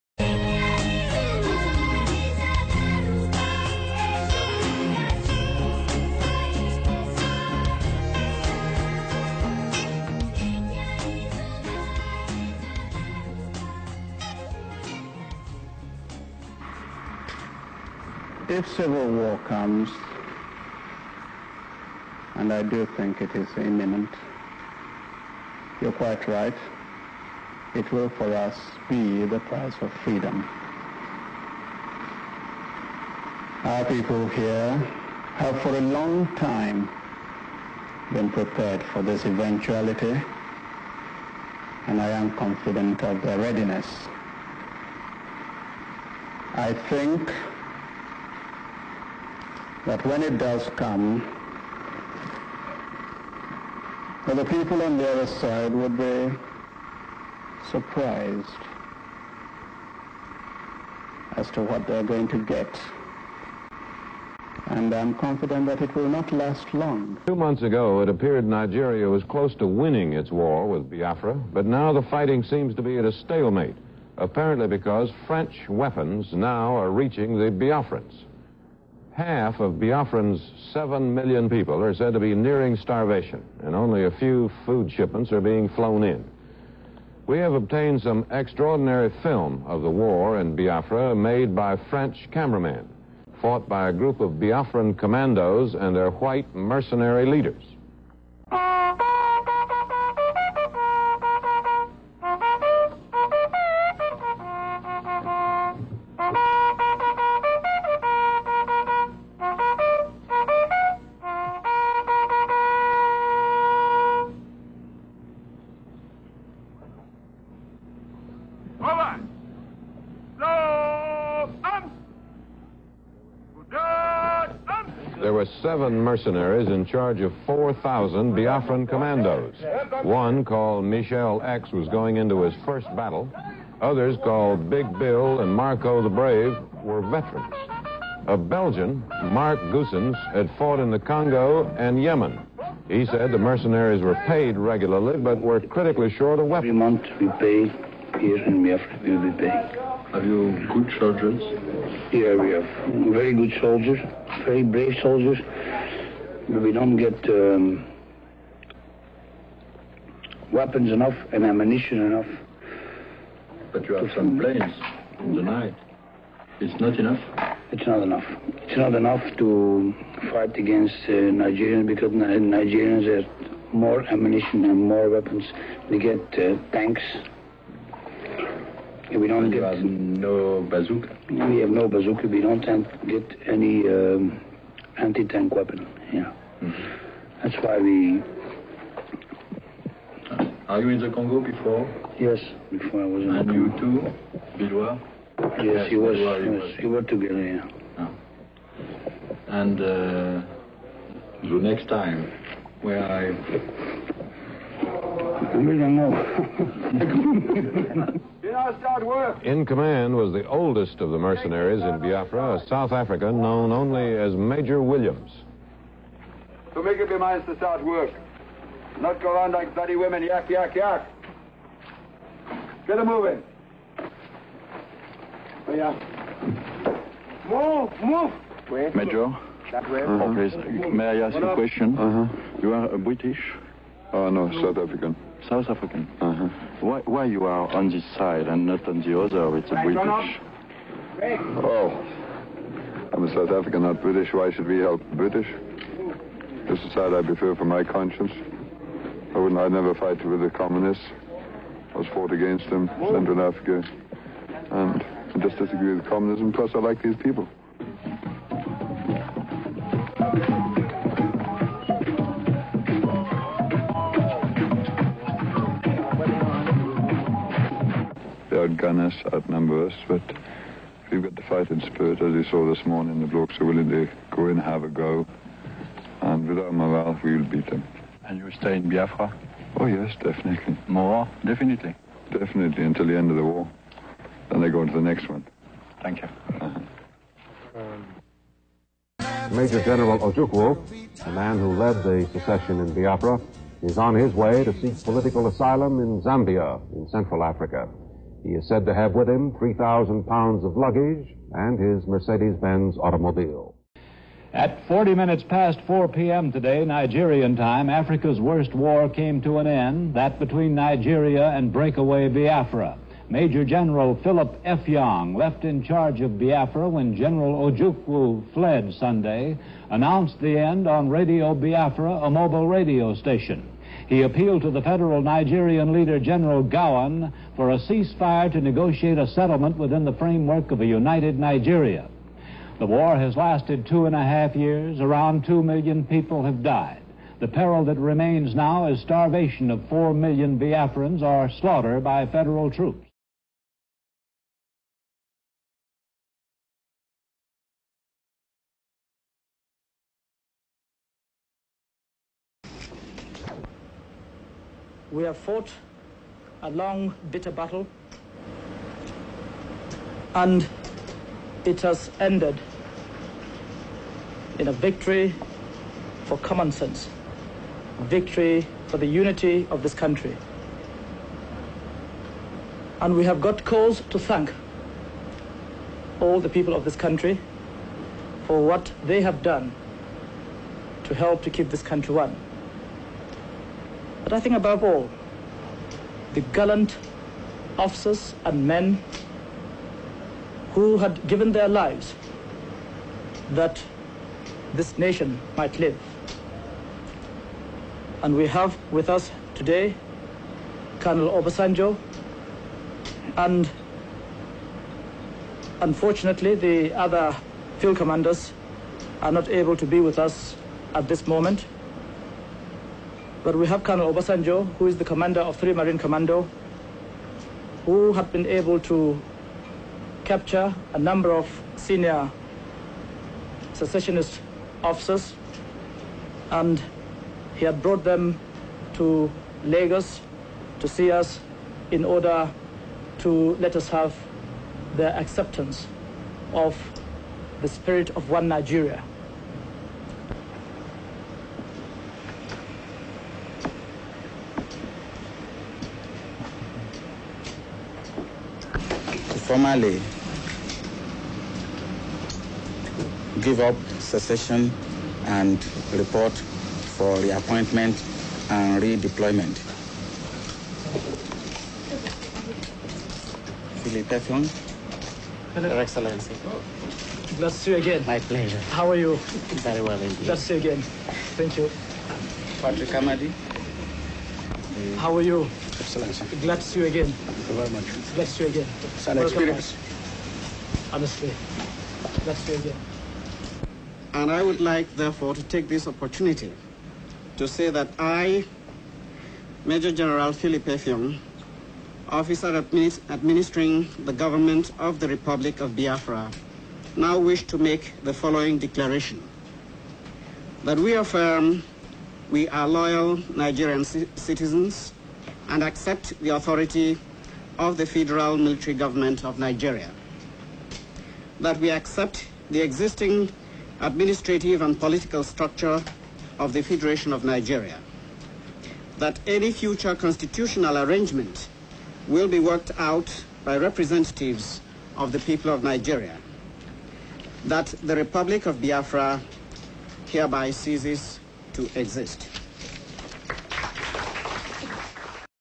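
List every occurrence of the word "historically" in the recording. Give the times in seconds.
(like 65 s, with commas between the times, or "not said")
not said.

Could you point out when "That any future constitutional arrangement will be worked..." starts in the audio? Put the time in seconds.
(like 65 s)
518 s.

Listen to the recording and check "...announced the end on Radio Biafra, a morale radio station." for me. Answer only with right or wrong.
wrong.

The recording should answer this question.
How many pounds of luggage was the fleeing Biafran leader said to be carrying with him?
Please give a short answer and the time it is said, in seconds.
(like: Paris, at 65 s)
3,000, at 299 s.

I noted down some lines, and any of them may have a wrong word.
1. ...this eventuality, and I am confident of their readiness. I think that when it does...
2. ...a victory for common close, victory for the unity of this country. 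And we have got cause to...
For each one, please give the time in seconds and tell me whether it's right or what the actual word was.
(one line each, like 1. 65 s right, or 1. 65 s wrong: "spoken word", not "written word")
1. 39 s right
2. 364 s wrong: "sense", not "close".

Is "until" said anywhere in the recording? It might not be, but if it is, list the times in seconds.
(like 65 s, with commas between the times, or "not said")
282 s.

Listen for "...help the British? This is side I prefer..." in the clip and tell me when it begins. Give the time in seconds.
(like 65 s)
244 s.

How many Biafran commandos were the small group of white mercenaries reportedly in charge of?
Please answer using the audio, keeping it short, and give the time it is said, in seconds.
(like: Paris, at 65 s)
4,000, at 127 s.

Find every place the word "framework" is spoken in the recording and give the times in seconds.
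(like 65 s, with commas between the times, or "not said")
330 s.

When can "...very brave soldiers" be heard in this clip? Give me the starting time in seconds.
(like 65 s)
154 s.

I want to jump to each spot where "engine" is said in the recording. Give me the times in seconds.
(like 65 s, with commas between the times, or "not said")
not said.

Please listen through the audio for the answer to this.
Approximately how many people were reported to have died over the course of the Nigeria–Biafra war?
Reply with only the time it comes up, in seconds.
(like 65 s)
335 s.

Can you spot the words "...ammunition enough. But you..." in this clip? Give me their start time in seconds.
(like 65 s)
161 s.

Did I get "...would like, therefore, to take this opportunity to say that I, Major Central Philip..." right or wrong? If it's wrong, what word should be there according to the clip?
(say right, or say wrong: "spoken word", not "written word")
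wrong: "General", not "Central".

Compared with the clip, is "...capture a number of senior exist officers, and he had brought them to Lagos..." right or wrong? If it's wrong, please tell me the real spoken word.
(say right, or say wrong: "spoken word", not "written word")
wrong: "secessionist", not "exist".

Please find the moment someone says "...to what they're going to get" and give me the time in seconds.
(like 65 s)
61 s.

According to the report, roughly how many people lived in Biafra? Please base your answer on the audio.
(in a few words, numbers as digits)
7 million.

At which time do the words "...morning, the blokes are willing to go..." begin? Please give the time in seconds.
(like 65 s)
272 s.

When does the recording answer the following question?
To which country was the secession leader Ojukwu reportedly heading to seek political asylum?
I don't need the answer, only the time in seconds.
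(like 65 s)
296 s.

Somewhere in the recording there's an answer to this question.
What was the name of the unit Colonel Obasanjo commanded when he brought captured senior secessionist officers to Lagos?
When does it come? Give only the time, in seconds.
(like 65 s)
415 s.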